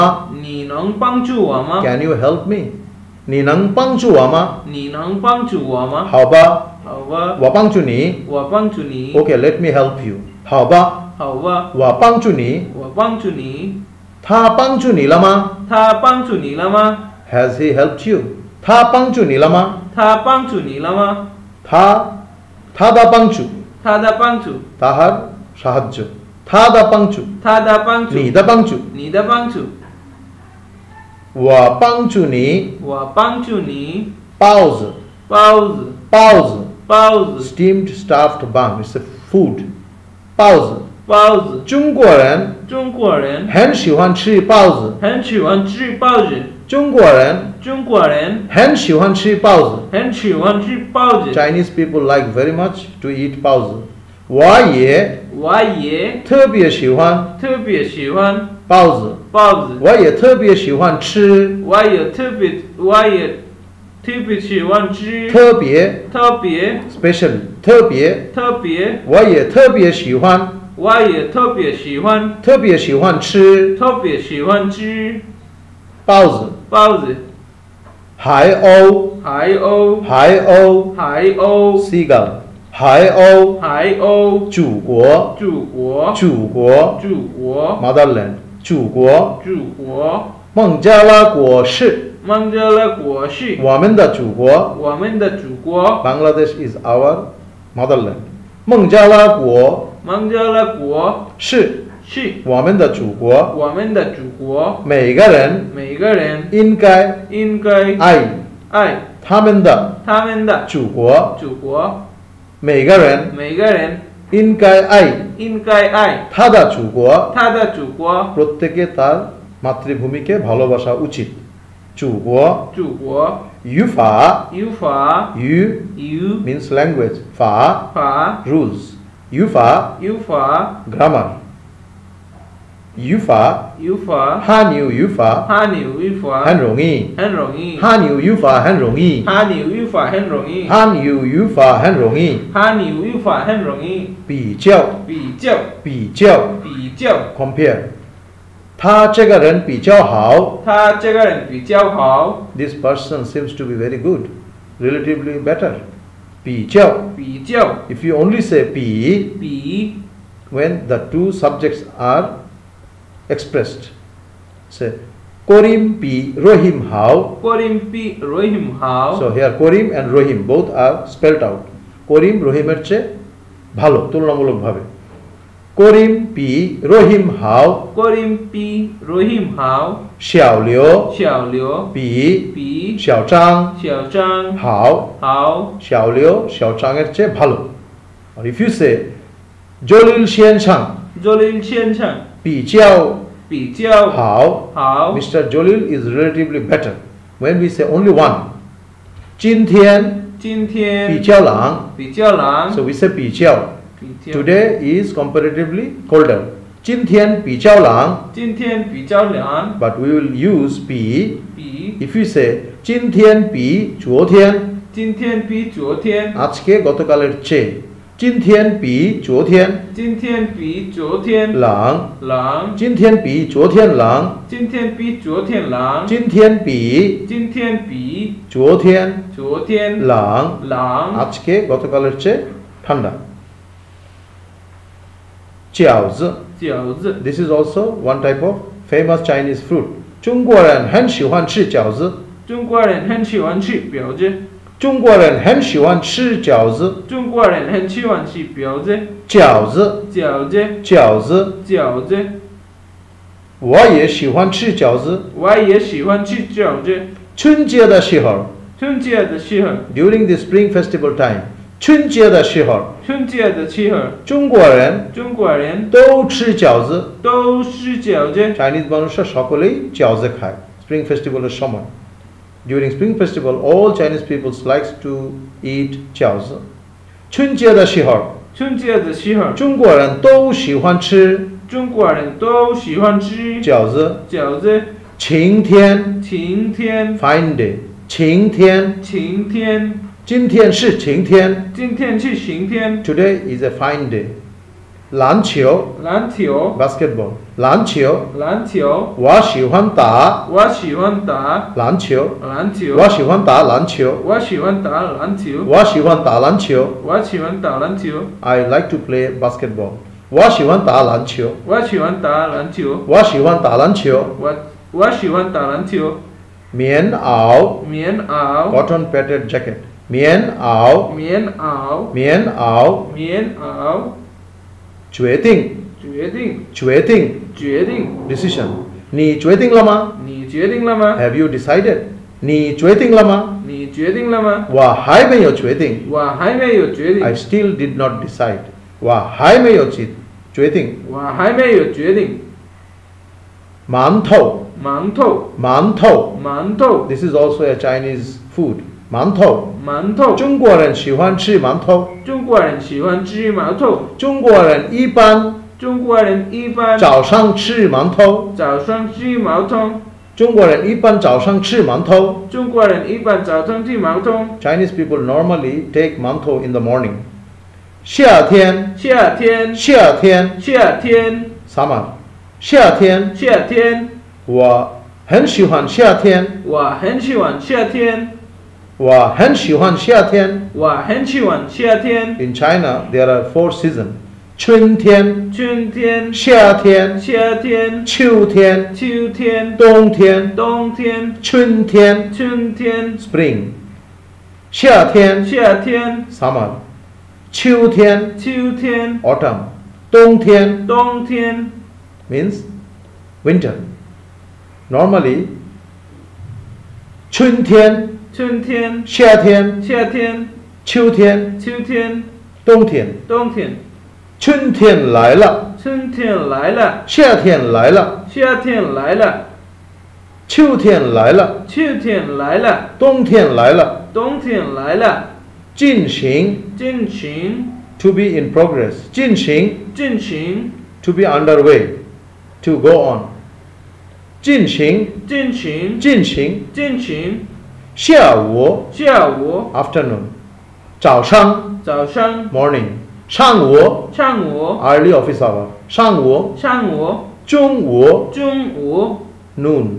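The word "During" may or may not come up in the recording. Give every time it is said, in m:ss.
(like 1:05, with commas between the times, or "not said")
4:19, 4:32.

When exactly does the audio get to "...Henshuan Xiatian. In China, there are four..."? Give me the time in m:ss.
6:21.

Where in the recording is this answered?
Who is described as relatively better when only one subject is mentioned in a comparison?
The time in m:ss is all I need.
3:15.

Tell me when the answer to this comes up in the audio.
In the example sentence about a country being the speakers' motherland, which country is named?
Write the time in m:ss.
1:36.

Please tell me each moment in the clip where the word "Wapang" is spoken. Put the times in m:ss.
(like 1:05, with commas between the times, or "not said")
0:07, 0:11.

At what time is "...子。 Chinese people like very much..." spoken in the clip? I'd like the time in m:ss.
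0:51.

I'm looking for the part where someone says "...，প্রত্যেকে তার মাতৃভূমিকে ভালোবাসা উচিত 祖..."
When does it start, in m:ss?
1:58.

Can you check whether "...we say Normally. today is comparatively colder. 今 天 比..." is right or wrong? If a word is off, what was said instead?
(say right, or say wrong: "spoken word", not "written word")
wrong: "Chiao", not "Normally".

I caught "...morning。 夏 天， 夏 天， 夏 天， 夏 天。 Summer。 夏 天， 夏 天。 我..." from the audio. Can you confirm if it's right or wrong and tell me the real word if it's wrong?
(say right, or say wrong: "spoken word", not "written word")
right.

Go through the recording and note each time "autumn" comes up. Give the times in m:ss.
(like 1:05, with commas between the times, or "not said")
6:24, 6:39.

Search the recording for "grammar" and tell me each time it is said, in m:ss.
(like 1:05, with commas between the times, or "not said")
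2:10.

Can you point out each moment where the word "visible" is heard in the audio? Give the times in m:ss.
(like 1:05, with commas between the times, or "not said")
not said.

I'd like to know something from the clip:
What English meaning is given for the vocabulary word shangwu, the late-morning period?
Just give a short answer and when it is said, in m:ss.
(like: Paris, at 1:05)
early office hour, at 7:24.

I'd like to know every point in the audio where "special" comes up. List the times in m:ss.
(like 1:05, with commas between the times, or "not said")
1:07.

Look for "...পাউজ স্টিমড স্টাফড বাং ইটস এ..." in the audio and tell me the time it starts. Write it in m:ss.
0:36.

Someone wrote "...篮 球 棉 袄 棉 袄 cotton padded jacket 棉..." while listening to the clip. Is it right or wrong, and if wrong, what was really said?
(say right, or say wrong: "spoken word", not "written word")
right.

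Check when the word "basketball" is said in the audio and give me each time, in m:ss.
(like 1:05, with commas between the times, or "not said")
4:56, 5:09.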